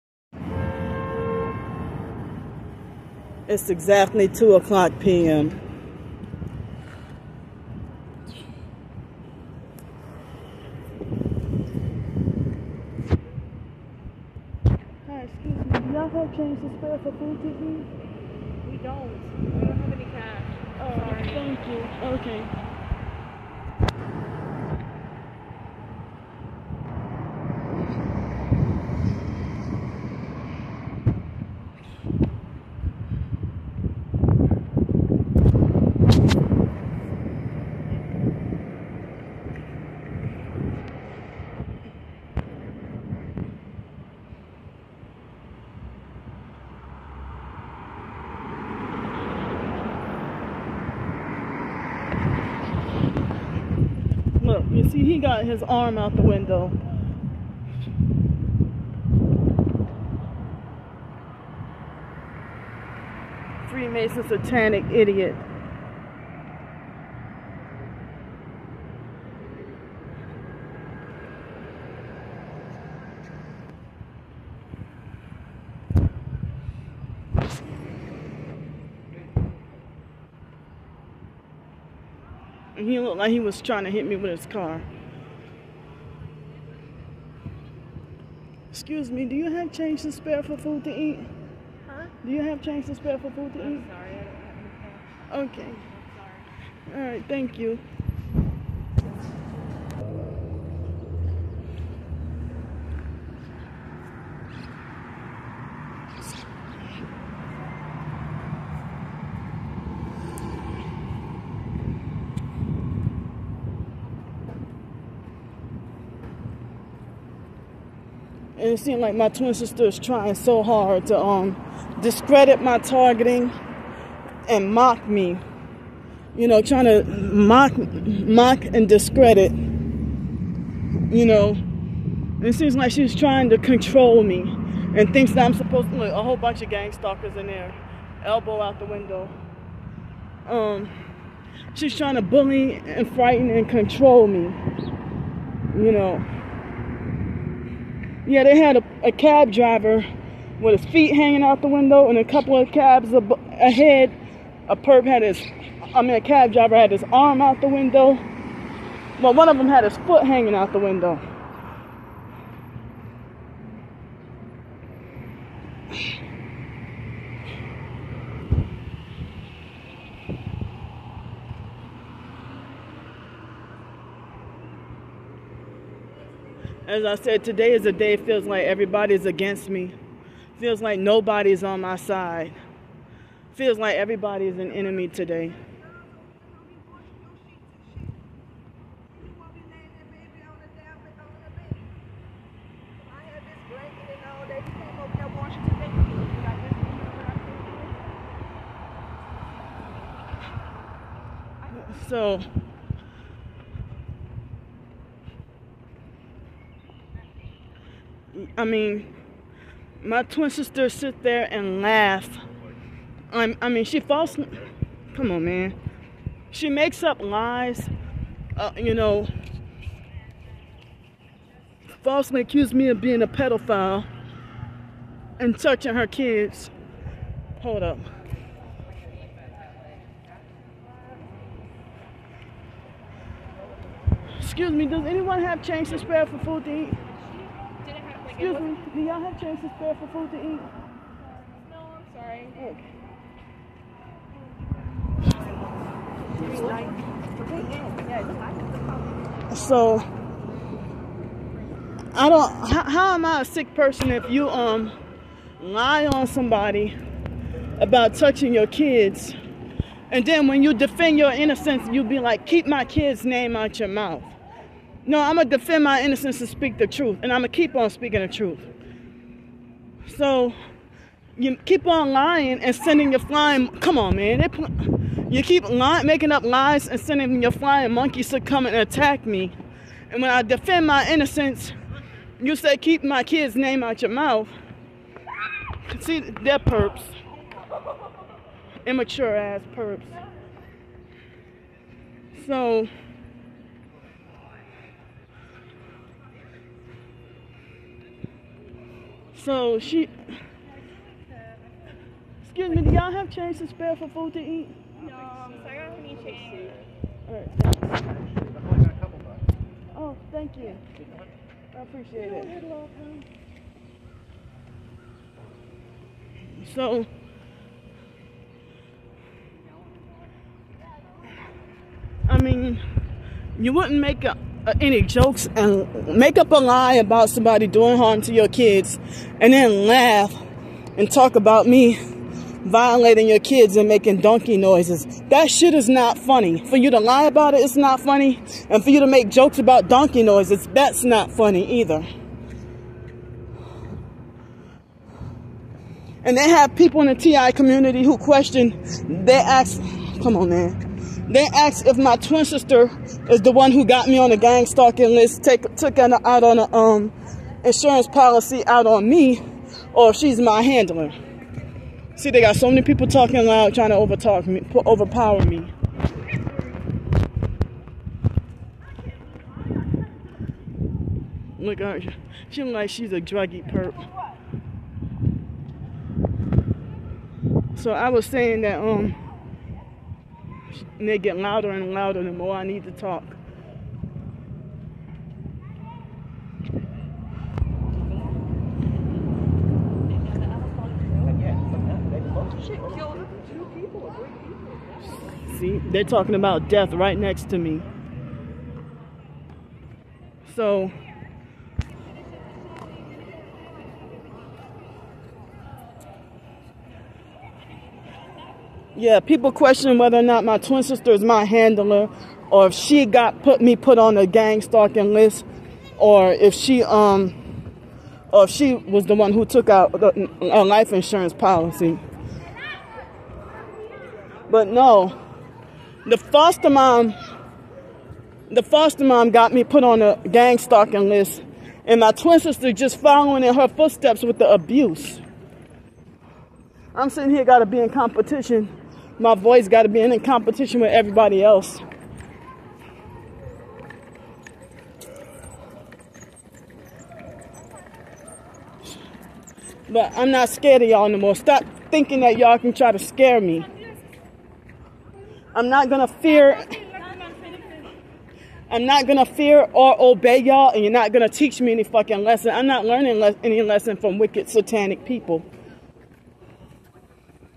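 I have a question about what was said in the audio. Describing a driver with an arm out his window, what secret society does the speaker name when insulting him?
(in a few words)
Freemason.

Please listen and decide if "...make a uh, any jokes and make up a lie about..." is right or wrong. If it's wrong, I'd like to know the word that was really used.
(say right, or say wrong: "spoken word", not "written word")
right.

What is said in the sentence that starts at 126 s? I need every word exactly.
You know, trying to mock, mock and discredit.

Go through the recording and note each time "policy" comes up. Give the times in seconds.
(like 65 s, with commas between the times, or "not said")
358 s, 421 s.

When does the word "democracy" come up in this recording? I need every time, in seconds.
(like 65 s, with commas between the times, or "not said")
not said.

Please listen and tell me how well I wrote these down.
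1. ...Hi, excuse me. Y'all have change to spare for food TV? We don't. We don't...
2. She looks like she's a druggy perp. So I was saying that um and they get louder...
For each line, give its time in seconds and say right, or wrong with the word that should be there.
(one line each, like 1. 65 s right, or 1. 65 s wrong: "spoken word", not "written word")
1. 15 s right
2. 372 s right.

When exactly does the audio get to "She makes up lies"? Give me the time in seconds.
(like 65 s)
216 s.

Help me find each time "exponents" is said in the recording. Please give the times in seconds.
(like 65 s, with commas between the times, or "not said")
not said.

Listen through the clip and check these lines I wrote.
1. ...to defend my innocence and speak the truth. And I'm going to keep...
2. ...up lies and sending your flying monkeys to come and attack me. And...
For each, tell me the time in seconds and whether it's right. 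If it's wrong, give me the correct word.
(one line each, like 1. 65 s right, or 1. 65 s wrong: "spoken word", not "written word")
1. 265 s right
2. 276 s right.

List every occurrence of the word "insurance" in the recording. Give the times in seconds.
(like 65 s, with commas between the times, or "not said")
357 s, 420 s.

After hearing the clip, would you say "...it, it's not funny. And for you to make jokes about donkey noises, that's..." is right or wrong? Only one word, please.
right.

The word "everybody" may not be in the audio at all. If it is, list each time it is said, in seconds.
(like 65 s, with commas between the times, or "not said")
178 s, 183 s, 440 s.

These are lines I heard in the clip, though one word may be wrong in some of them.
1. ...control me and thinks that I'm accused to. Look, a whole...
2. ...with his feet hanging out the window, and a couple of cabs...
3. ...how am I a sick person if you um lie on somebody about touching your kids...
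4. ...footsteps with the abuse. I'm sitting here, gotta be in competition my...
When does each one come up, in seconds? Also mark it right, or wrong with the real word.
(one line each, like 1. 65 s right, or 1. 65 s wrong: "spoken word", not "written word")
1. 133 s wrong: "supposed", not "accused"
2. 150 s right
3. 252 s right
4. 433 s right.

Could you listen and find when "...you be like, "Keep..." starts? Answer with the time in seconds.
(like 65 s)
261 s.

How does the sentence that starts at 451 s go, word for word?
Stop thinking that y'all can try to scare me.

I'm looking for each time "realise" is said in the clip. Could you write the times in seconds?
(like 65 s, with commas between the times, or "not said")
not said.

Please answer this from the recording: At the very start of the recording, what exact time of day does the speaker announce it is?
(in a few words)
2 p.m.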